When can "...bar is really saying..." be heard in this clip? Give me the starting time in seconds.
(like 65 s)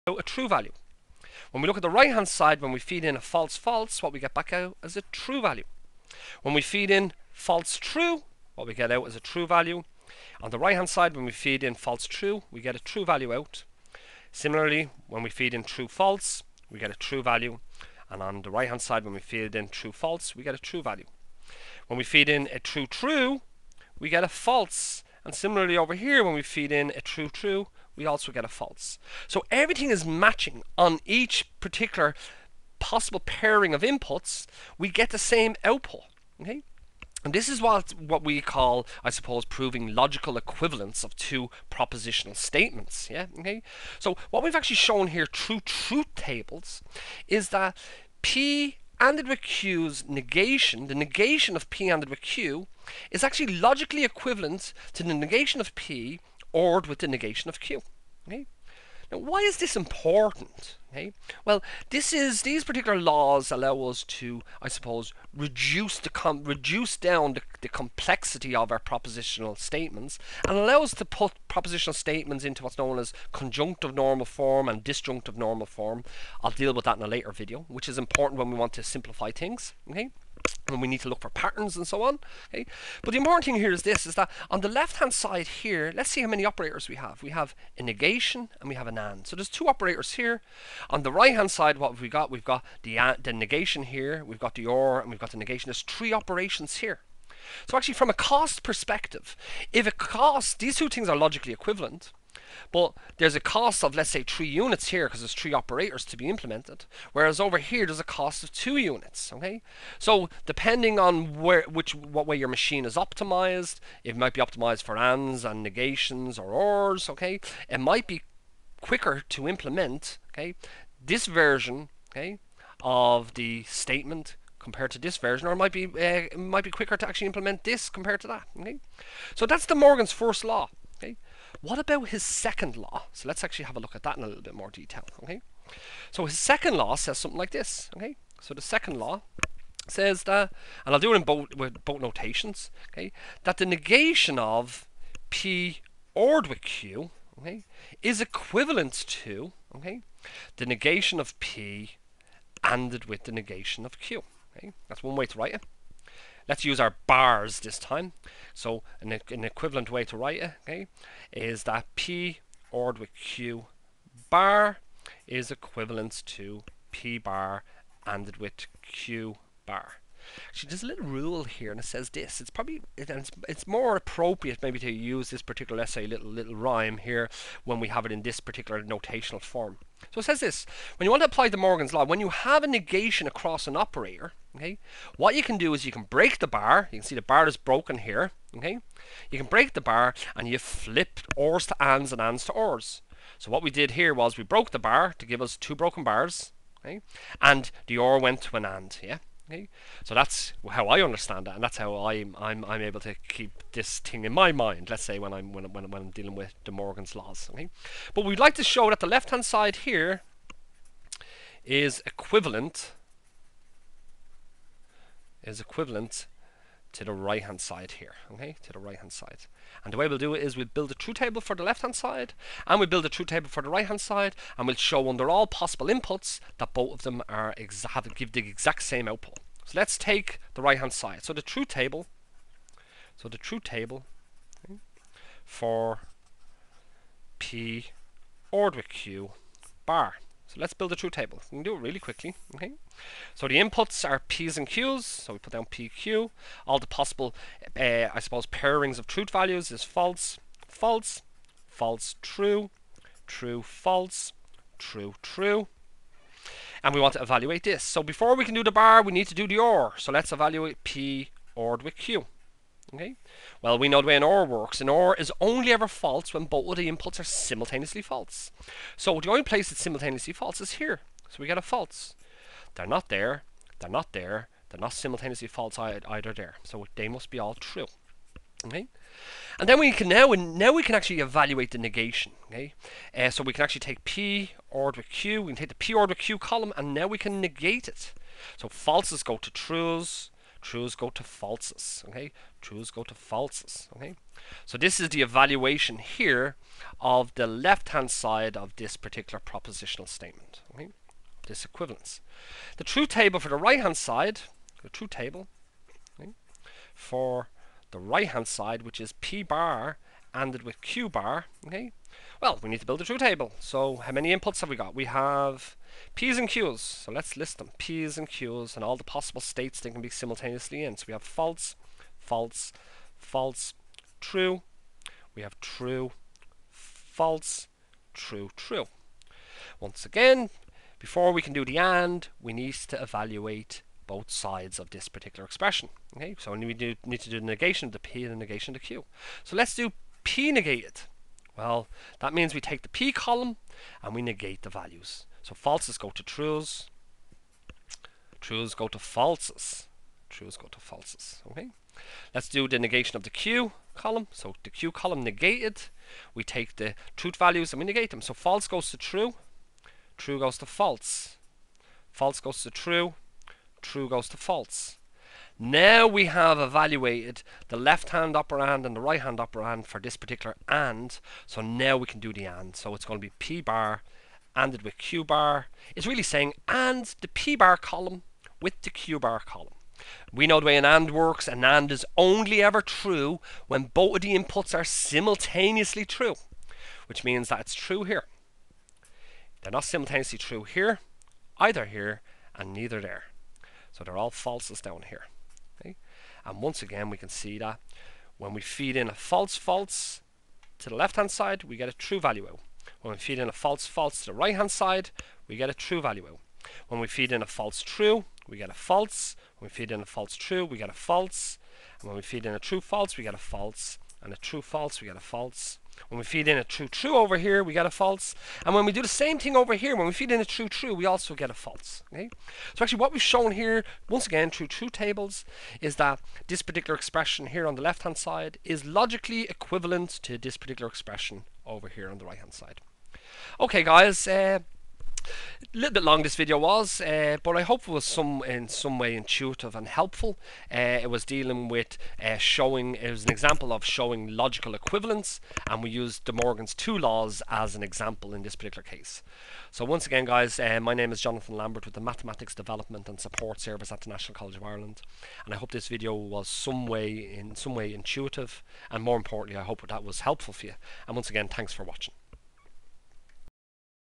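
375 s.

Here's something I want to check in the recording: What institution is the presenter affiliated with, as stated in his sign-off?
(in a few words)
National College of Ireland.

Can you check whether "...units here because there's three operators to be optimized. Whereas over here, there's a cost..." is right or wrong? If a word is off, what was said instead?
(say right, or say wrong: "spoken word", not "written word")
wrong: "implemented", not "optimized".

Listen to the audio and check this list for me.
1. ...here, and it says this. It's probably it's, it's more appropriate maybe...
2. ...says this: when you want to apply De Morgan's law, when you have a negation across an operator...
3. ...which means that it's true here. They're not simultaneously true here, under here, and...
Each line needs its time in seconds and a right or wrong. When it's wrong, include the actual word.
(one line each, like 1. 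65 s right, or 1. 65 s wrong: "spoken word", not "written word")
1. 171 s right
2. 180 s right
3. 387 s wrong: "either", not "under".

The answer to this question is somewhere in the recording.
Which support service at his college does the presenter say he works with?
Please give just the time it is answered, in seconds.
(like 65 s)
452 s.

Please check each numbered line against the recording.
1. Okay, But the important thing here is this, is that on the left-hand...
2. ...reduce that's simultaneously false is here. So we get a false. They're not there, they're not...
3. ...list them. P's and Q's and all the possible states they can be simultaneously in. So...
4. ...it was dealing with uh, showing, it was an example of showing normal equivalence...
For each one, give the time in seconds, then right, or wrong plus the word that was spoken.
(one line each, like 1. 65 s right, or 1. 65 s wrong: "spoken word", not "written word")
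1. 82 s right
2. 269 s wrong: "place", not "reduce"
3. 317 s right
4. 441 s wrong: "logical", not "normal".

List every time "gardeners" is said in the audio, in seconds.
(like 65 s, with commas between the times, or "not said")
not said.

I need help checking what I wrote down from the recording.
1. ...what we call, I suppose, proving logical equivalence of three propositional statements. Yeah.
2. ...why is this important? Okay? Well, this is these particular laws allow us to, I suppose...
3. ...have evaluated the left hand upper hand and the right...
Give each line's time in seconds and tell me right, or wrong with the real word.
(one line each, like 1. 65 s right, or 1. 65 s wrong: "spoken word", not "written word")
1. 37 s wrong: "two", not "three"
2. 59 s right
3. 366 s right.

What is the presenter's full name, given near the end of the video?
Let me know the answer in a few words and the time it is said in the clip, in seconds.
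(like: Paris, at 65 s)
Jonathan Lambert, at 451 s.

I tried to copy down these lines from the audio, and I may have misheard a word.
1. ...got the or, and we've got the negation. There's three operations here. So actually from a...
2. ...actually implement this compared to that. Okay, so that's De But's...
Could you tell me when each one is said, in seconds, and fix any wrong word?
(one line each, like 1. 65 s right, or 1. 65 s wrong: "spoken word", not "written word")
1. 94 s right
2. 127 s wrong: "Morgan", not "But".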